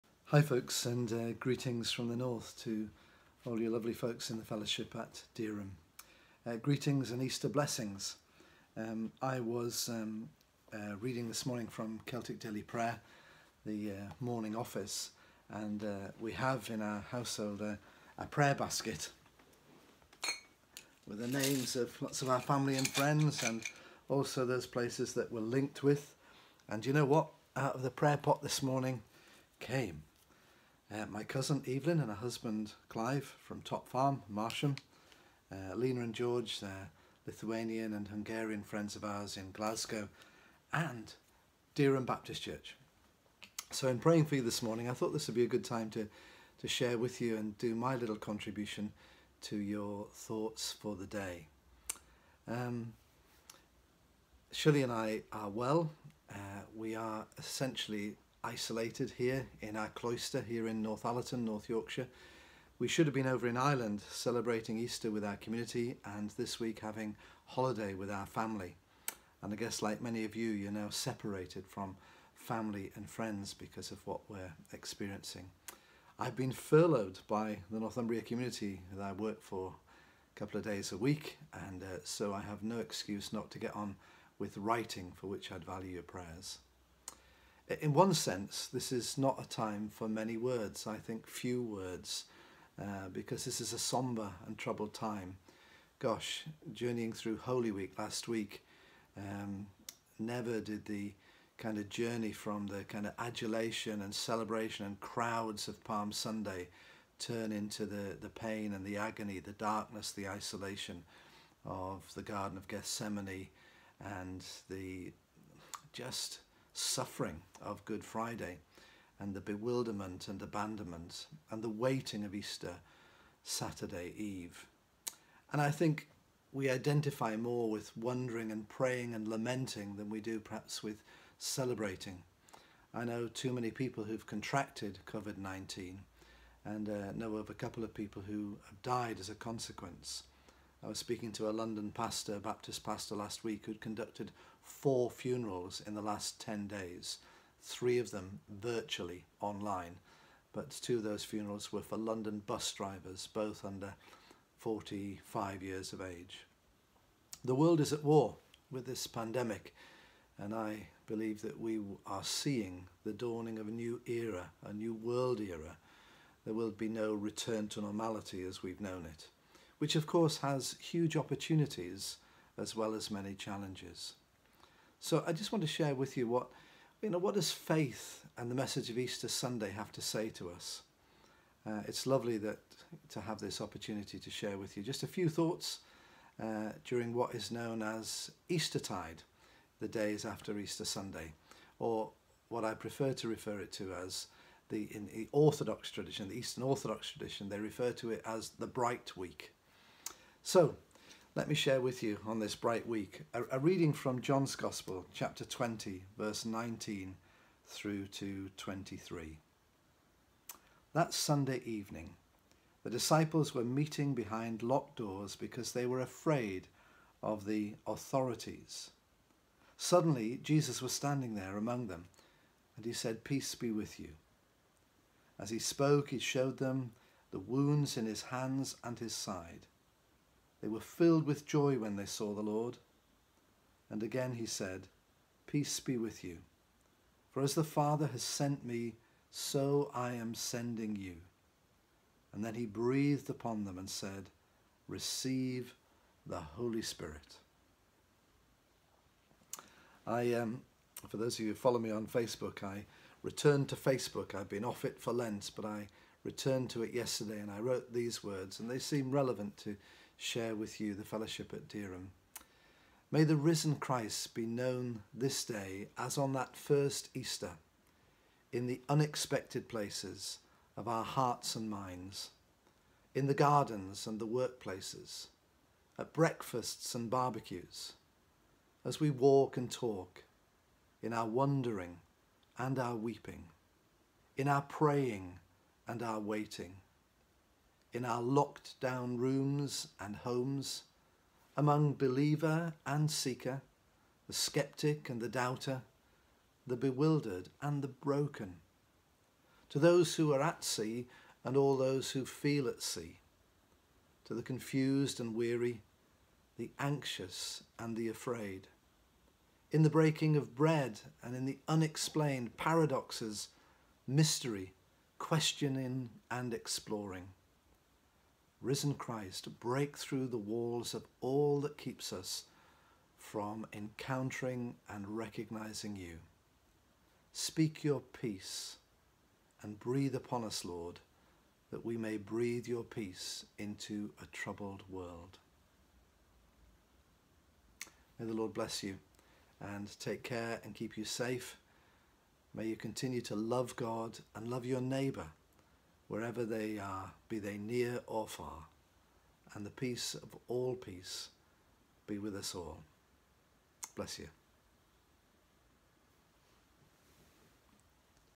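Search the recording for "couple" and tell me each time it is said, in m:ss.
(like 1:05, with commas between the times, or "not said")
1:20, 2:17.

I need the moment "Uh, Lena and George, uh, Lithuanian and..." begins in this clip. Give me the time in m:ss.
0:35.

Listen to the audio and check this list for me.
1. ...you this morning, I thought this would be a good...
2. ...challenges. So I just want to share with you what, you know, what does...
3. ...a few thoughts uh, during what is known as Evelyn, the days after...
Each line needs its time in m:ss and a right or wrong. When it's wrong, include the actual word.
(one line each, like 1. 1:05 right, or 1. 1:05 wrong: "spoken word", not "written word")
1. 0:44 right
2. 2:53 right
3. 3:05 wrong: "Eastertide", not "Evelyn".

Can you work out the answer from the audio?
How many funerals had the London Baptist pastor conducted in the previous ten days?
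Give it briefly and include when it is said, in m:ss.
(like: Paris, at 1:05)
4, at 2:24.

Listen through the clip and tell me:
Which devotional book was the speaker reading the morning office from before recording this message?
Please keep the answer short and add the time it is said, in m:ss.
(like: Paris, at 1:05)
Celtic Daily Prayer, at 0:12.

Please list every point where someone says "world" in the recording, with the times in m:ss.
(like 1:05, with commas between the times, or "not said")
2:37, 2:44, 5:34.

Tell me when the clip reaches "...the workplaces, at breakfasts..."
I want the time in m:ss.
4:34.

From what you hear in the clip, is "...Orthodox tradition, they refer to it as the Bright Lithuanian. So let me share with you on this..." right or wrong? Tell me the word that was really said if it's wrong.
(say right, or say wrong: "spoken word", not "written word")
wrong: "Week", not "Lithuanian".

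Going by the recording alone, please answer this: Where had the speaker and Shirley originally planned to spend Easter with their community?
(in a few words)
Ireland.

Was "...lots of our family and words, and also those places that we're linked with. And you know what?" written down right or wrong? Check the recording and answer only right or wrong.
wrong.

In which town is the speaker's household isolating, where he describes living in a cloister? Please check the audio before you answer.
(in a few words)
Northallerton.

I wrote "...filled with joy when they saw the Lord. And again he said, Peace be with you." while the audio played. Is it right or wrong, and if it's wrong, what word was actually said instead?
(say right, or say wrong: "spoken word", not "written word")
right.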